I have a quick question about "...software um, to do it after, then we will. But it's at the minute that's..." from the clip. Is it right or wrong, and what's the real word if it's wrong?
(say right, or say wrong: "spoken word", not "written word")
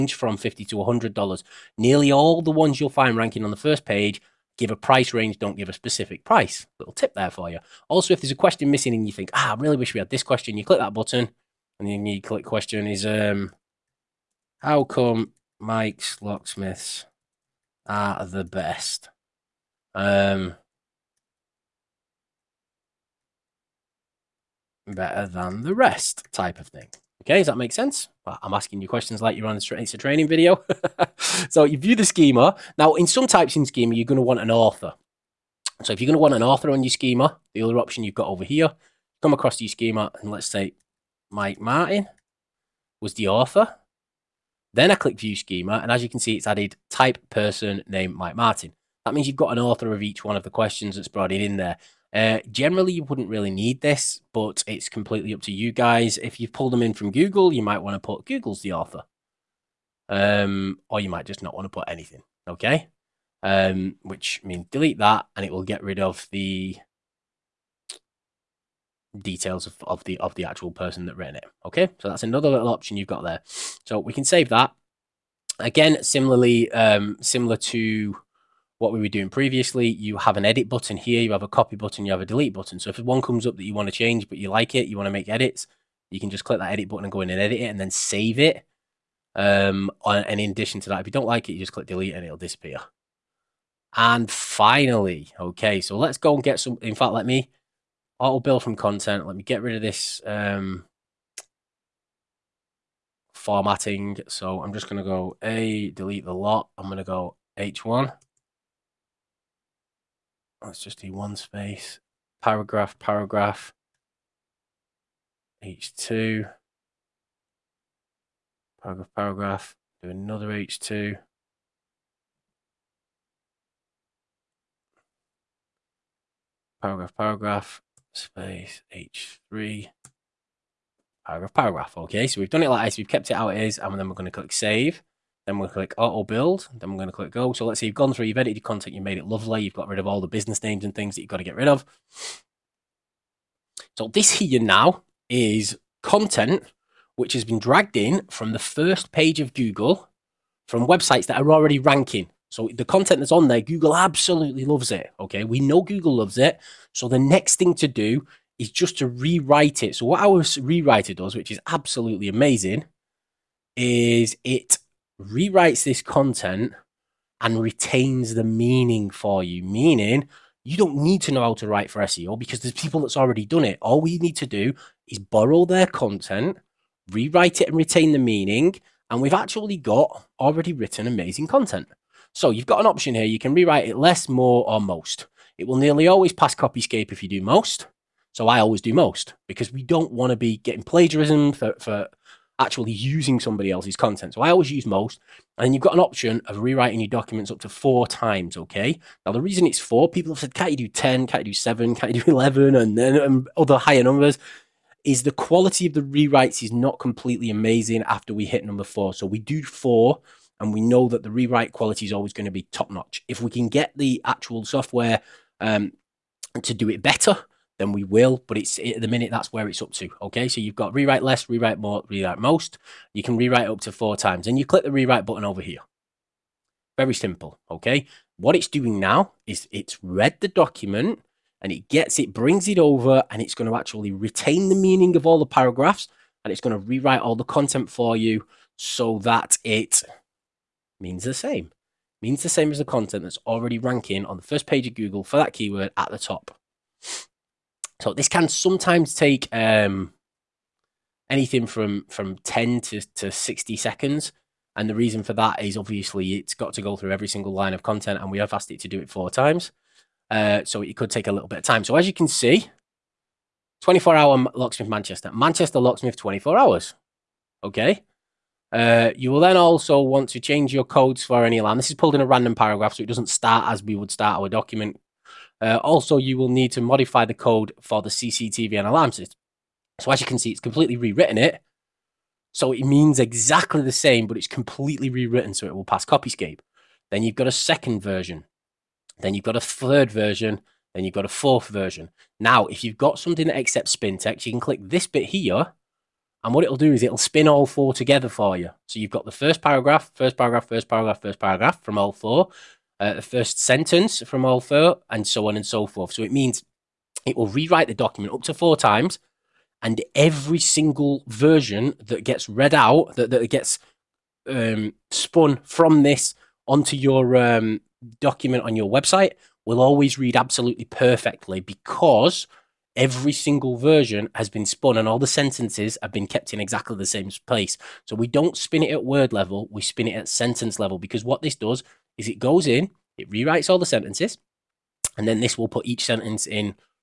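wrong: "better", not "after".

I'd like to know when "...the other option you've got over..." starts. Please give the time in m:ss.
0:37.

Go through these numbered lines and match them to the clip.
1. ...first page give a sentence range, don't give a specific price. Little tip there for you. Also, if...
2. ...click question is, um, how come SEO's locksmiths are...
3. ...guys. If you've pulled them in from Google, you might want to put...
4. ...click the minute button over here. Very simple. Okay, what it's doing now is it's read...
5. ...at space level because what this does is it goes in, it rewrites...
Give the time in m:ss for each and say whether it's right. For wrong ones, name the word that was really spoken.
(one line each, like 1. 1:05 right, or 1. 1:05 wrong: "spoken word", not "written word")
1. 0:03 wrong: "price", not "sentence"
2. 0:12 wrong: "Mike", not "SEO"
3. 0:55 right
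4. 3:44 wrong: "rewrite", not "minute"
5. 5:30 wrong: "sentence", not "space".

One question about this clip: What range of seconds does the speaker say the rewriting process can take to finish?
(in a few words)
10 to 60 seconds.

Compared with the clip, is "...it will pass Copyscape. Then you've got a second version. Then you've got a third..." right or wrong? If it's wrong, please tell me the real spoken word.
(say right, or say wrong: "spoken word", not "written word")
right.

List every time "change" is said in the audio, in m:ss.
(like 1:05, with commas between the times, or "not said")
1:23, 4:30.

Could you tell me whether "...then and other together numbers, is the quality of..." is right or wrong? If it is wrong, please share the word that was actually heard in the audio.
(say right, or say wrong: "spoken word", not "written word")
wrong: "higher", not "together".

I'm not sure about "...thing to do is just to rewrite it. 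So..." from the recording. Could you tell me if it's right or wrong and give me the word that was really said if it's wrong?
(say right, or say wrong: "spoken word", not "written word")
right.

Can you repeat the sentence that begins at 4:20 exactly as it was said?
Uh, so it could take a little bit of time.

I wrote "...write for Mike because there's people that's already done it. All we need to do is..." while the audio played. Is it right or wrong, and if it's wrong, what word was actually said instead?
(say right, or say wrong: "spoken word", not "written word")
wrong: "SEO", not "Mike".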